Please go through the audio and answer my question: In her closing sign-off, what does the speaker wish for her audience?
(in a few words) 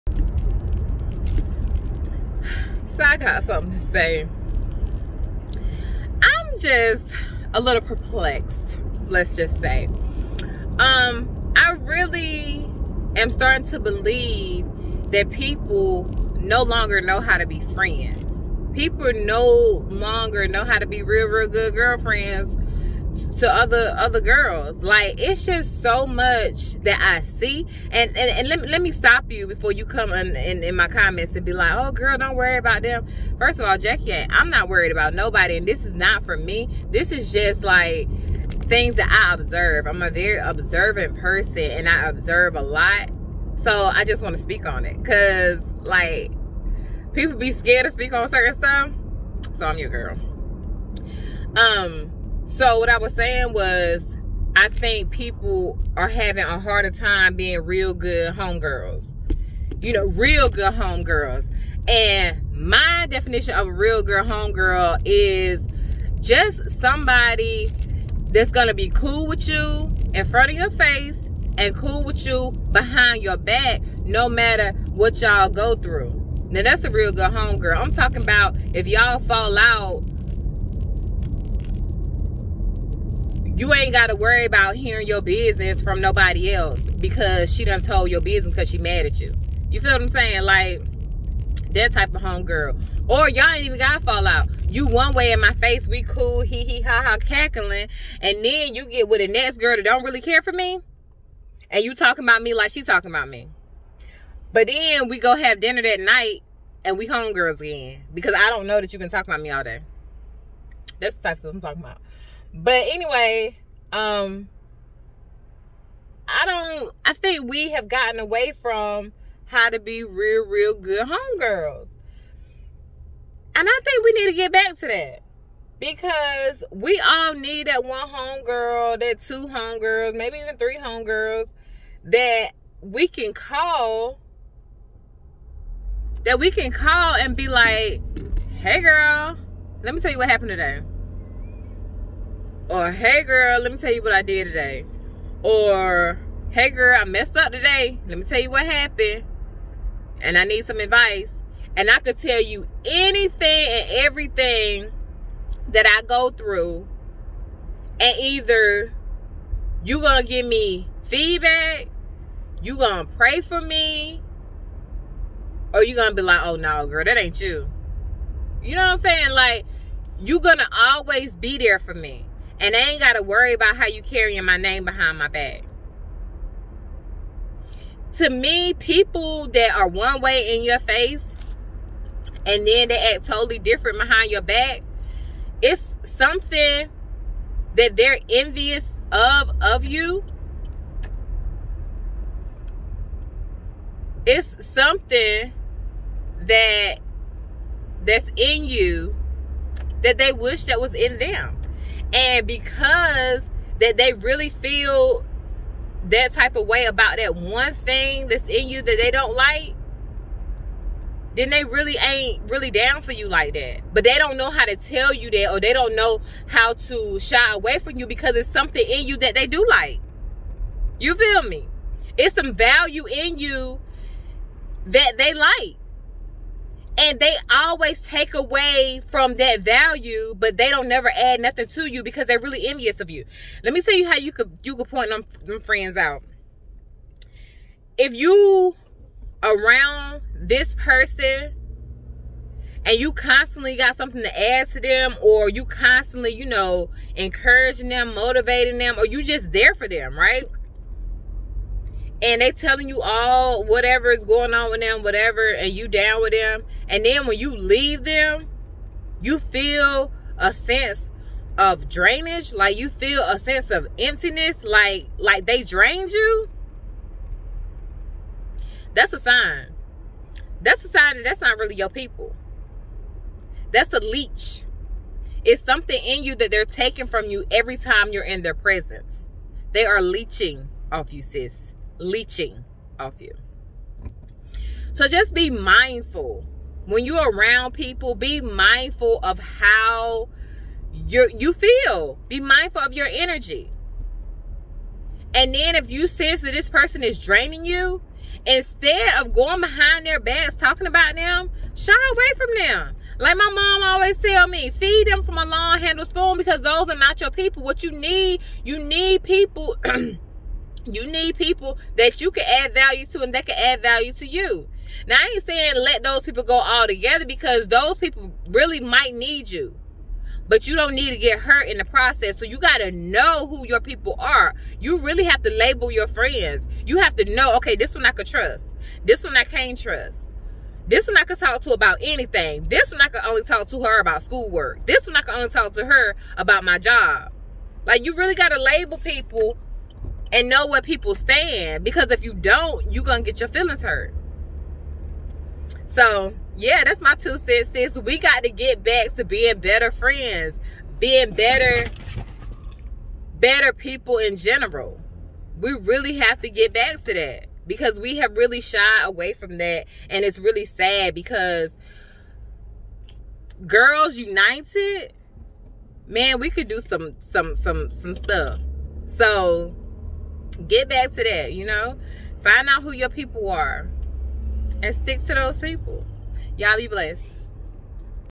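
be blessed.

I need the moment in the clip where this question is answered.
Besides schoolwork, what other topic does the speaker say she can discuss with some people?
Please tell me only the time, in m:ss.
5:36.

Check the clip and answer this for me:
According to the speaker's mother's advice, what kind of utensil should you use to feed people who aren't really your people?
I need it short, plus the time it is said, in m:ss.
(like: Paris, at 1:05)
long handle spoon, at 5:05.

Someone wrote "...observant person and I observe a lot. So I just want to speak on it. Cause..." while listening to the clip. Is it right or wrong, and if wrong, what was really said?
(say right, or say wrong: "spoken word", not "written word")
right.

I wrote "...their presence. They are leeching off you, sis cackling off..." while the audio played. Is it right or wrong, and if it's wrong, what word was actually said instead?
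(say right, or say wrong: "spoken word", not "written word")
wrong: "leeching", not "cackling".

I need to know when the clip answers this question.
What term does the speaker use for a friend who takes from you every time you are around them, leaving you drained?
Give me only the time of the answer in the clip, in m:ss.
4:33.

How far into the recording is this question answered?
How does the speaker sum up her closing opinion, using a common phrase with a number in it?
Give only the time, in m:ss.
5:47.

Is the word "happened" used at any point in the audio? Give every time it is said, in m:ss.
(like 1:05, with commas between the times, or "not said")
2:20, 2:28.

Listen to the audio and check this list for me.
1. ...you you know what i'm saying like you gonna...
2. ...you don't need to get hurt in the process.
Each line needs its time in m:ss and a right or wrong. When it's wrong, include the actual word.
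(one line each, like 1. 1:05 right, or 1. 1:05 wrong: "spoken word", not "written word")
1. 2:47 right
2. 5:20 right.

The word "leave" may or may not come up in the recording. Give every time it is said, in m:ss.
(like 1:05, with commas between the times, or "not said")
4:17.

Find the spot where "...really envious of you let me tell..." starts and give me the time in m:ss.
3:52.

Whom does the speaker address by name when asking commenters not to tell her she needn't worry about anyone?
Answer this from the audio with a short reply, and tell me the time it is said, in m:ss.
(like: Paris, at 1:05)
Jackie, at 0:33.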